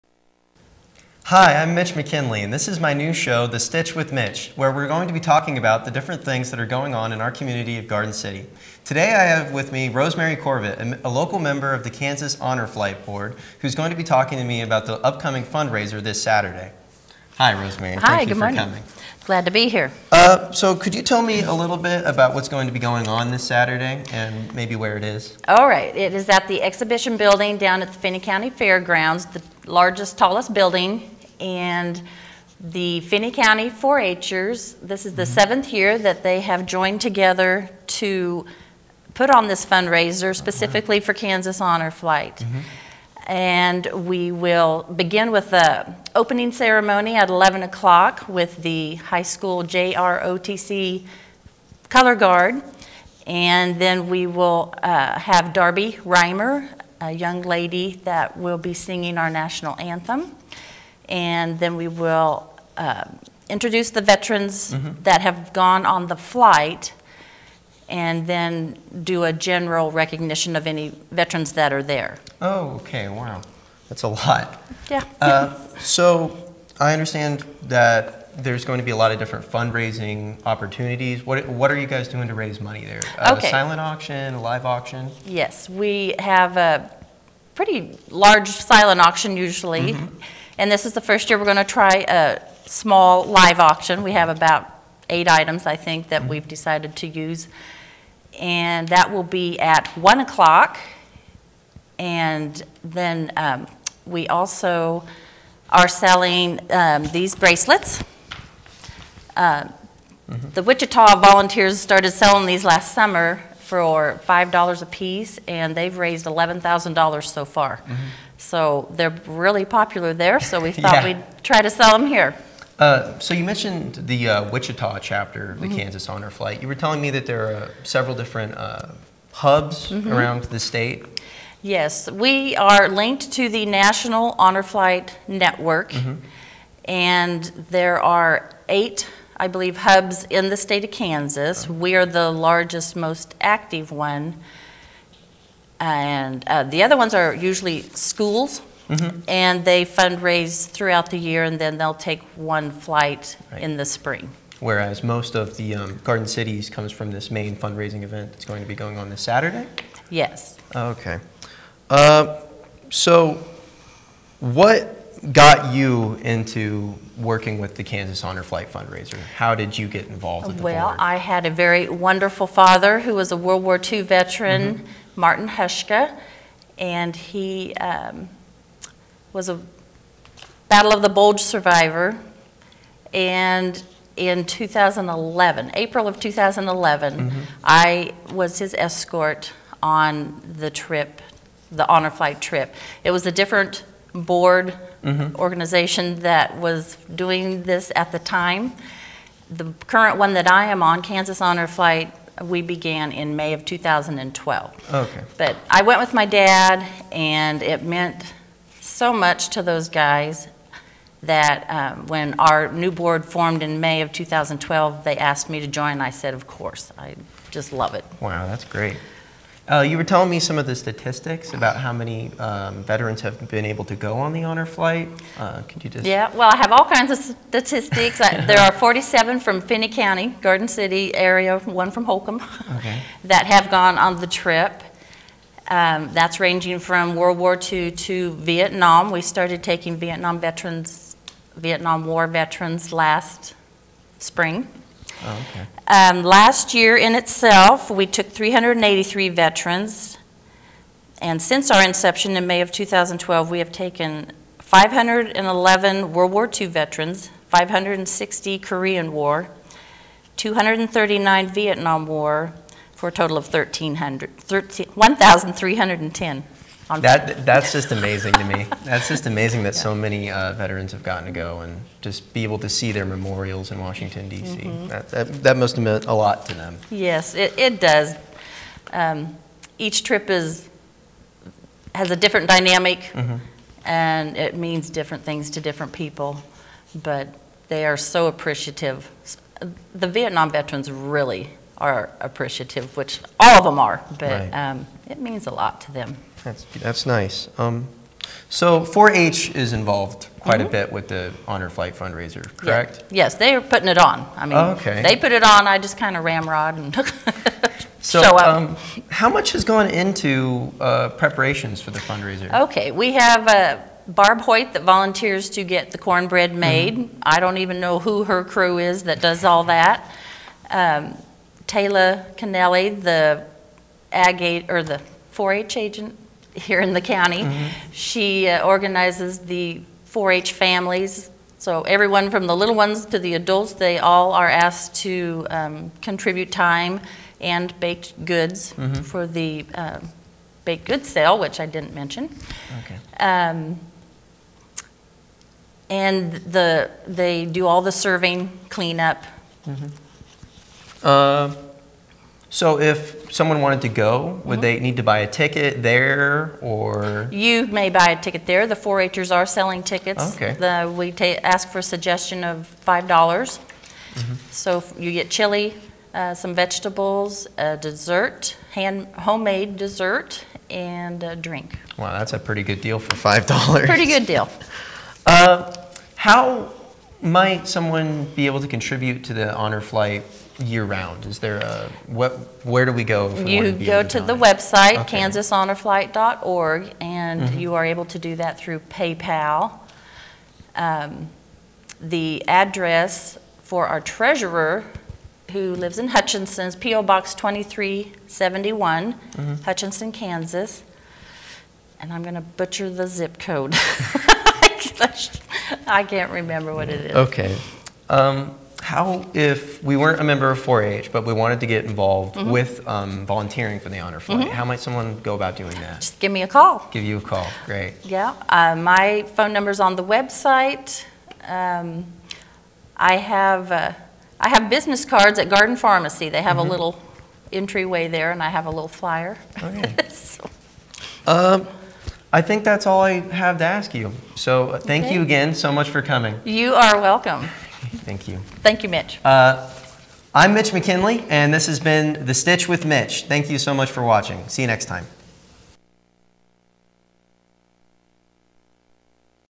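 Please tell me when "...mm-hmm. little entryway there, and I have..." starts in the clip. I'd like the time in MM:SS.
07:06.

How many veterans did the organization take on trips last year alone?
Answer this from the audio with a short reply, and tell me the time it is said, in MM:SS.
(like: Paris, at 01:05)
383, at 04:08.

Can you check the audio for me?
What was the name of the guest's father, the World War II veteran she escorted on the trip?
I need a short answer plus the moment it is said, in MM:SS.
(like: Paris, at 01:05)
Martin Hushka, at 02:55.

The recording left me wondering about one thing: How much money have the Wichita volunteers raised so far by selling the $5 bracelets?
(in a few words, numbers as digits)
$11,000.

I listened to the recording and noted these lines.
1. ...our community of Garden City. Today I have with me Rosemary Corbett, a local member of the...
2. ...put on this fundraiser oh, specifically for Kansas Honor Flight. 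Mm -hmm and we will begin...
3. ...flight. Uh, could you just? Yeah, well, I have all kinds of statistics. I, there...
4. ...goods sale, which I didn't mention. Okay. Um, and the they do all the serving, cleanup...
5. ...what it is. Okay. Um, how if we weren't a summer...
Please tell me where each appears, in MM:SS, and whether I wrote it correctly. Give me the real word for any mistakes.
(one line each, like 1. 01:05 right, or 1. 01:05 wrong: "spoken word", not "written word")
1. 00:07 right
2. 00:39 right
3. 03:44 right
4. 05:40 right
5. 06:46 wrong: "member", not "summer".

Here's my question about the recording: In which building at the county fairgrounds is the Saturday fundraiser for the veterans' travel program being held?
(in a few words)
Exhibition building.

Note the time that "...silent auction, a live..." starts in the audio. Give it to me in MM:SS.
01:23.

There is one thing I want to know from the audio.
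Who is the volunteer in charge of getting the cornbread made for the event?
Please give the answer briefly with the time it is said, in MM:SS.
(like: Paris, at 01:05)
Barb Hoyt, at 05:14.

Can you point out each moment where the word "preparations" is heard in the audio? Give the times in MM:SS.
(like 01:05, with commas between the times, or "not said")
05:11.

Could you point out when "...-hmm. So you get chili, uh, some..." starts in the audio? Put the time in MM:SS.
06:04.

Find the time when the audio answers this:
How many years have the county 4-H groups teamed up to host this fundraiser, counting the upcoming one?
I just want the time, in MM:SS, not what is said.
00:35.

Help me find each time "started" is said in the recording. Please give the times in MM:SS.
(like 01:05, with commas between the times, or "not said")
01:51, 03:59.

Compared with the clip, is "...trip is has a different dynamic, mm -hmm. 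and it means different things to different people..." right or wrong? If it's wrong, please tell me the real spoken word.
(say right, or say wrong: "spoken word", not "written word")
right.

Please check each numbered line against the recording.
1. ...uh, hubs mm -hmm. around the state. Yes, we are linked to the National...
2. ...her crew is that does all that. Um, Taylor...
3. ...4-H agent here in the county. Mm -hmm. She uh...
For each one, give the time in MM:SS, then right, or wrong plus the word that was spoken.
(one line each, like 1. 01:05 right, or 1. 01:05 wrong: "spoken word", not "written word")
1. 02:08 right
2. 05:18 right
3. 05:25 right.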